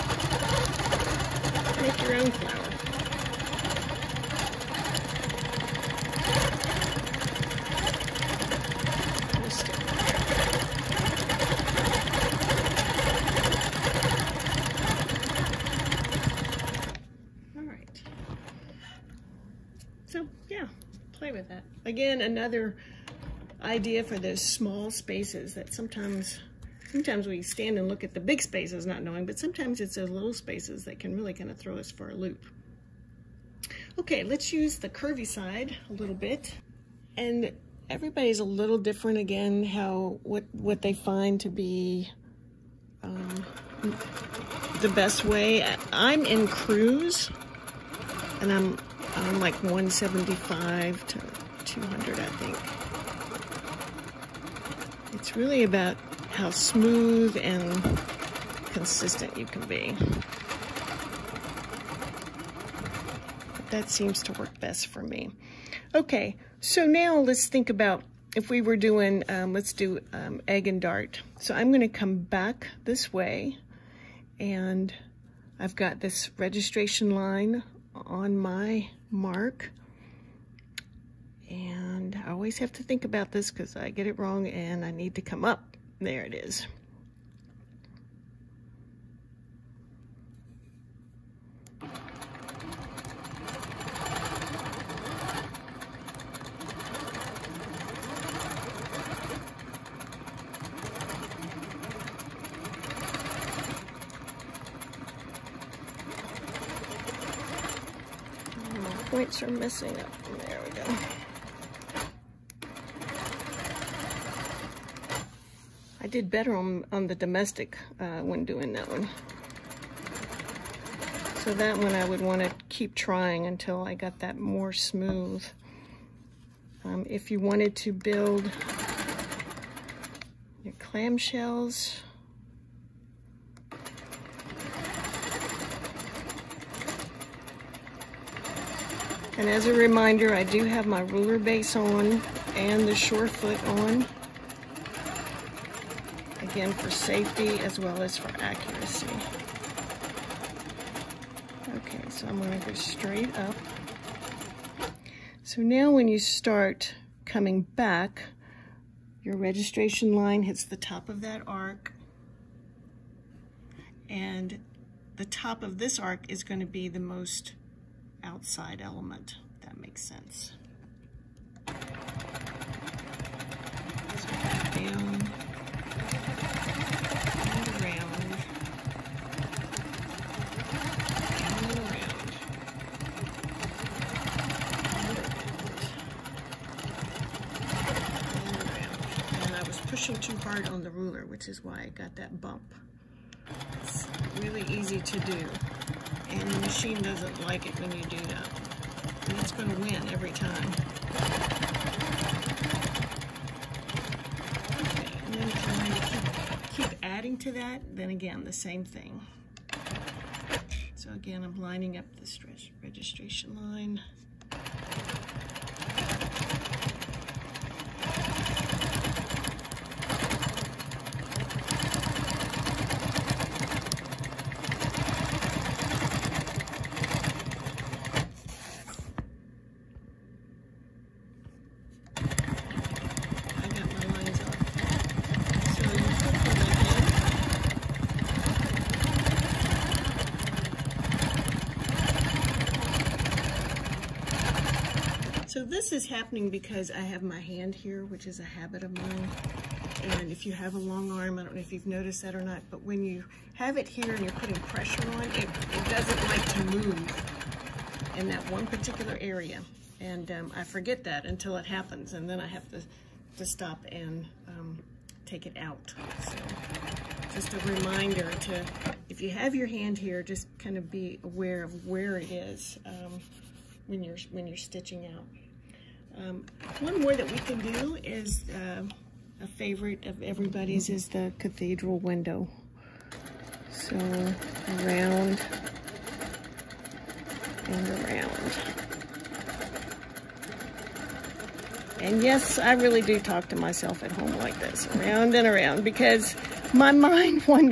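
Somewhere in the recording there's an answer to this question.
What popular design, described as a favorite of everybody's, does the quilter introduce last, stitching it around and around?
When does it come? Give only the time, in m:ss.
4:41.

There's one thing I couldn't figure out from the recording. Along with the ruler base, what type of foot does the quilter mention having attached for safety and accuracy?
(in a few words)
shore foot.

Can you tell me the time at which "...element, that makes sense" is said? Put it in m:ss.
2:48.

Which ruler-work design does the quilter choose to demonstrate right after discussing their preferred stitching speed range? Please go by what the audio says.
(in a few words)
egg and dart.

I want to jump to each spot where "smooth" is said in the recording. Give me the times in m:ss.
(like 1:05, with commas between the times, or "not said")
0:56, 2:04.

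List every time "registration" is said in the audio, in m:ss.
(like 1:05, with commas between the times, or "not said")
1:16, 2:39, 3:32.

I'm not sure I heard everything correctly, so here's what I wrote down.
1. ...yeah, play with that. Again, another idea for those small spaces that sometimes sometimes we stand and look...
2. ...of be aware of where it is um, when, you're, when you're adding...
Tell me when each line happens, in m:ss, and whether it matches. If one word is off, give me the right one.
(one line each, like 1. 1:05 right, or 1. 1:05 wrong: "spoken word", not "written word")
1. 0:20 right
2. 4:30 wrong: "stitching", not "adding".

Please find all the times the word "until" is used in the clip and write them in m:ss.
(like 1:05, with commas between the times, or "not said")
2:03, 4:21.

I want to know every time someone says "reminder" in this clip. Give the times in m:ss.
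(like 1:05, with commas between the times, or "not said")
2:19, 4:27.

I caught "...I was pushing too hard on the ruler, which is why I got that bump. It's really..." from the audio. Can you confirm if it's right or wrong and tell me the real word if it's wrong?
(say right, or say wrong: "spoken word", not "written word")
right.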